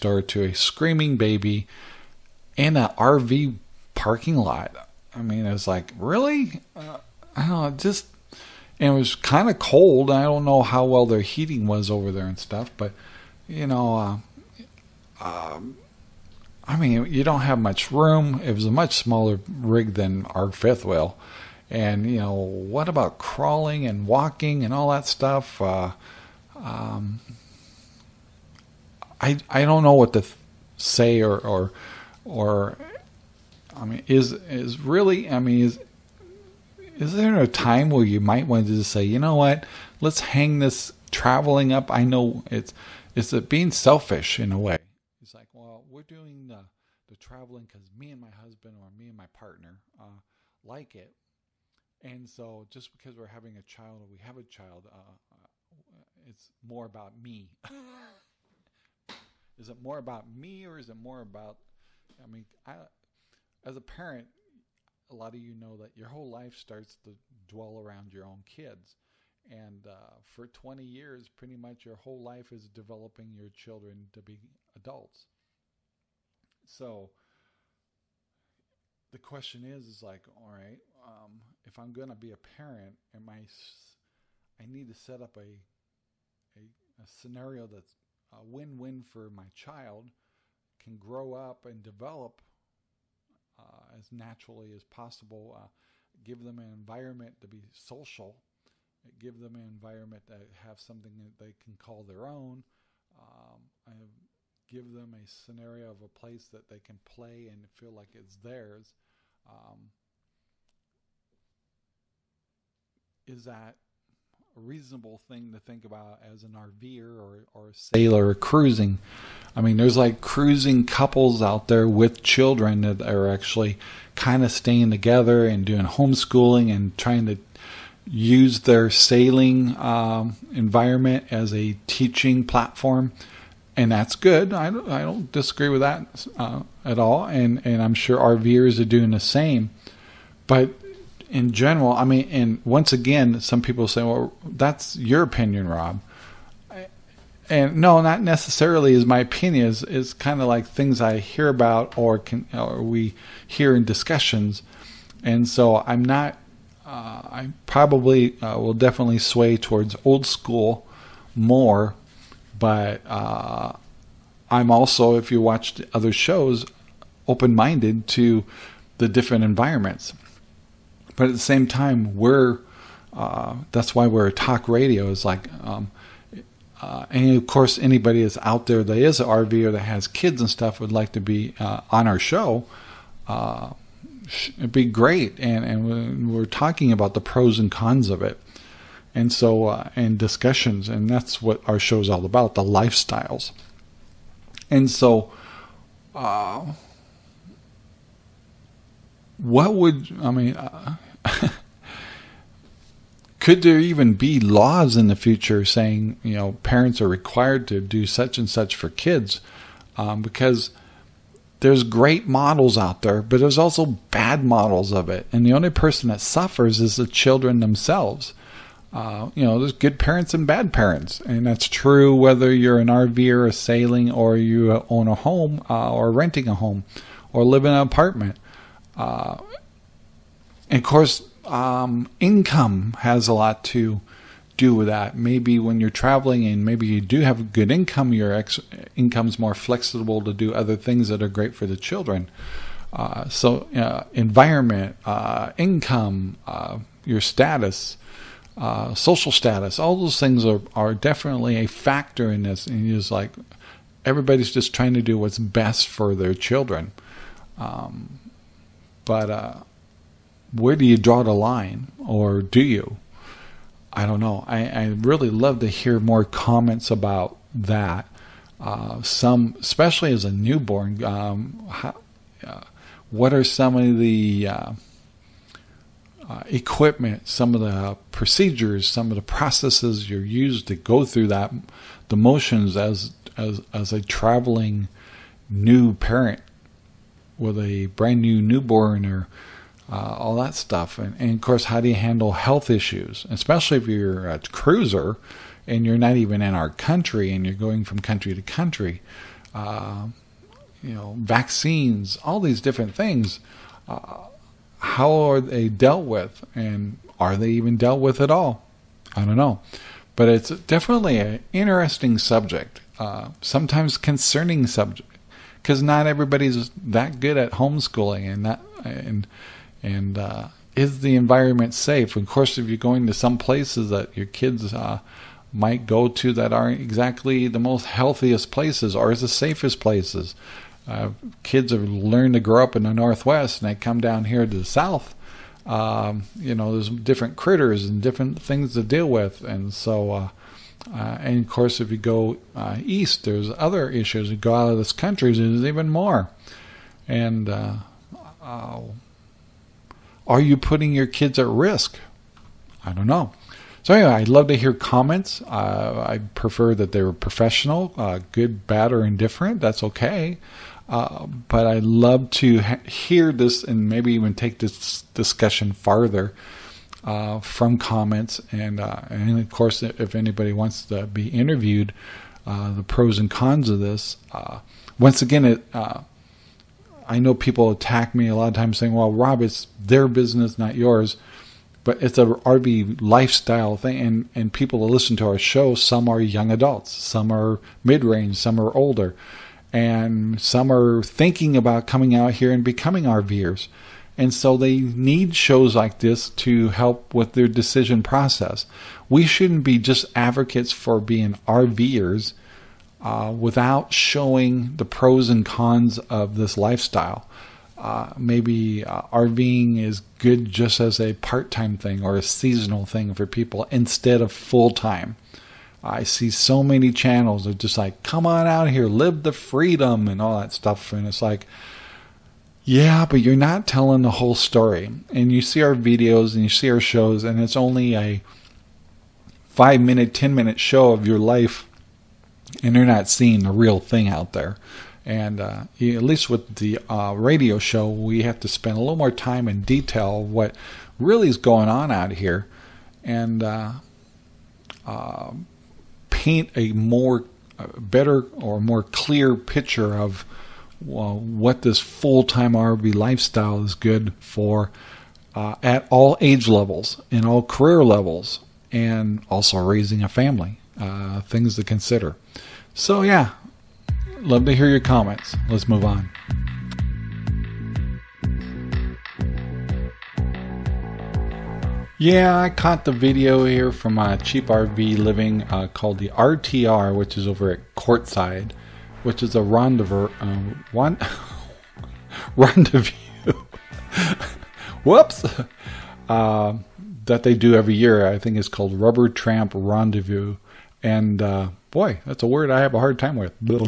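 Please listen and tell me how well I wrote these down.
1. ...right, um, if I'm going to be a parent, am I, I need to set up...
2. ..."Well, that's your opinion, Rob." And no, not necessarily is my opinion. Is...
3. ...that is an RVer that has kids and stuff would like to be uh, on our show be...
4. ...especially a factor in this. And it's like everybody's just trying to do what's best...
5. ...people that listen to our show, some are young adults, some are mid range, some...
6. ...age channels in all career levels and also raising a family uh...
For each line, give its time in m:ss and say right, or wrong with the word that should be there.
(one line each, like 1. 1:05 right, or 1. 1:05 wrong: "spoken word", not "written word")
1. 1:20 right
2. 2:24 right
3. 2:58 right
4. 4:10 wrong: "definitely", not "especially"
5. 6:24 right
6. 7:36 wrong: "levels", not "channels".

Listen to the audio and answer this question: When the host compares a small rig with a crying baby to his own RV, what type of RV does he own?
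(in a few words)
fifth wheel.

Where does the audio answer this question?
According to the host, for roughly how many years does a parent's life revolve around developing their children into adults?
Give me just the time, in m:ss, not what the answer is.
1:10.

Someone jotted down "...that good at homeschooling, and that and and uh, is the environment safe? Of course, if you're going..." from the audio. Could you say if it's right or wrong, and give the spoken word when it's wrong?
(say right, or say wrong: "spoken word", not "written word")
right.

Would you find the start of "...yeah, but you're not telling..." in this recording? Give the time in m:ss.
7:02.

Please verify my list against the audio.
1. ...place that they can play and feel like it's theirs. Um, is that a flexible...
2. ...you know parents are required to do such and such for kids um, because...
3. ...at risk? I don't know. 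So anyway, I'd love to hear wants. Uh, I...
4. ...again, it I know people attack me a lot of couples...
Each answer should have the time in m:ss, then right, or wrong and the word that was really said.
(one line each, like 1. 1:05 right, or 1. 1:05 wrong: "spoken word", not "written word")
1. 1:46 wrong: "reasonable", not "flexible"
2. 3:26 right
3. 5:51 wrong: "comments", not "wants"
4. 6:15 wrong: "times", not "couples".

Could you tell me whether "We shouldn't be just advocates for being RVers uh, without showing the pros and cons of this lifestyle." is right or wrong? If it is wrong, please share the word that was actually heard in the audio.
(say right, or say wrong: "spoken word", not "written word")
right.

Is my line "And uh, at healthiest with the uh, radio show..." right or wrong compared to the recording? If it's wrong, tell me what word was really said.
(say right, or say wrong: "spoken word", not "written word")
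wrong: "least", not "healthiest".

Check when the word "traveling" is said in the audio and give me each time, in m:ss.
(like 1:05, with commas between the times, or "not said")
0:41, 0:47, 3:55, 4:44.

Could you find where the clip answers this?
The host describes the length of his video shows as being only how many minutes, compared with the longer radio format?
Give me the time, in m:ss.
7:09.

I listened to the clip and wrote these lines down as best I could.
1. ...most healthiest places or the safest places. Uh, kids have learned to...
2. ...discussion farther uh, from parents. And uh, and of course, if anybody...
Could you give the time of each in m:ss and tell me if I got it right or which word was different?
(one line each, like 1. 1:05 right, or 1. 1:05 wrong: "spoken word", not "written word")
1. 5:27 right
2. 6:05 wrong: "comments", not "parents".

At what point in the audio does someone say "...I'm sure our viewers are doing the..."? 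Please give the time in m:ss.
2:17.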